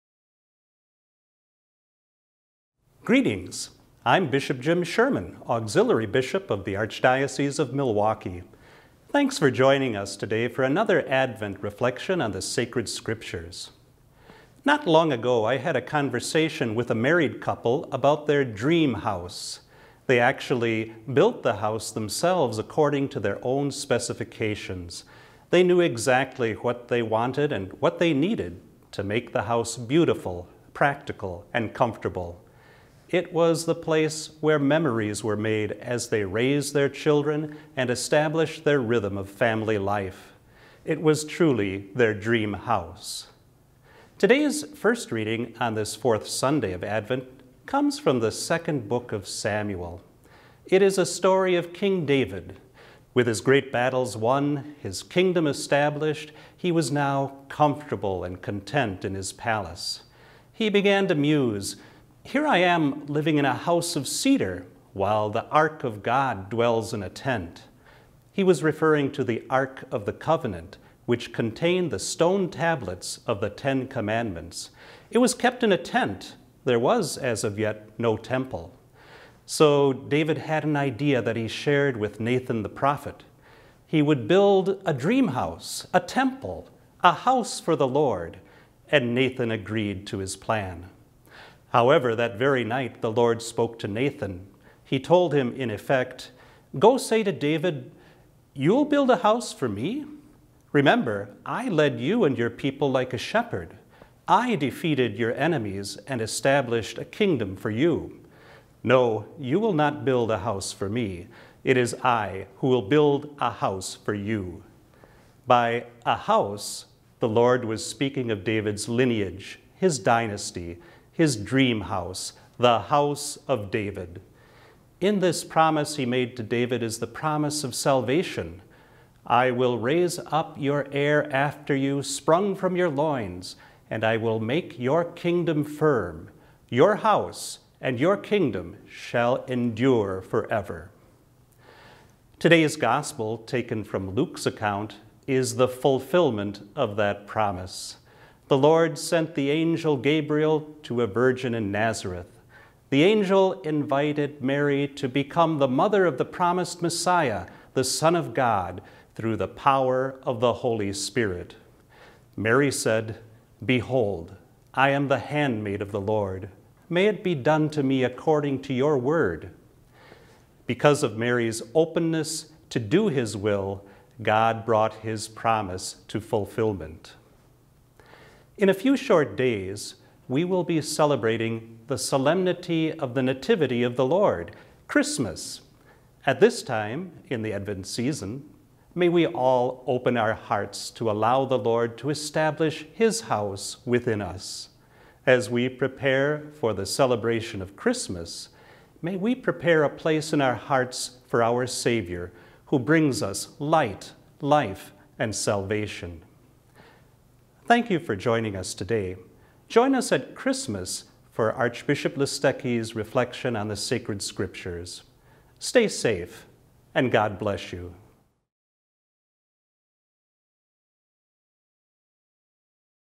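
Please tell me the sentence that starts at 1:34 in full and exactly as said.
He told him, in effect, Go say to David, You'll build a house for me?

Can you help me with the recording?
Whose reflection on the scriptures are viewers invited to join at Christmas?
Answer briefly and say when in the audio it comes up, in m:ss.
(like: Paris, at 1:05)
Archbishop Listecki, at 3:31.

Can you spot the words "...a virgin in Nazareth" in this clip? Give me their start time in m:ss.
2:31.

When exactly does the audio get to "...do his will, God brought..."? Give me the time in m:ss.
2:52.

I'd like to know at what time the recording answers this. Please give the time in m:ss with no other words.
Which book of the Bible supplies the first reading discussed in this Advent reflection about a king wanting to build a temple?
0:48.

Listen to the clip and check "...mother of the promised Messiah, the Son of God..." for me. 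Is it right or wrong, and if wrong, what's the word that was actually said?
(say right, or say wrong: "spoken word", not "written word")
right.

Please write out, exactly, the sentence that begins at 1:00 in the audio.
He began to muse here I am living in a house of cedar while the ark of God dwells in a tent.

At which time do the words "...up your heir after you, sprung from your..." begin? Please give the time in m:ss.
2:10.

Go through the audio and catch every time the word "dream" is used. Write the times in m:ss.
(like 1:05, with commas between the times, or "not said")
0:18, 0:42, 1:24, 2:01.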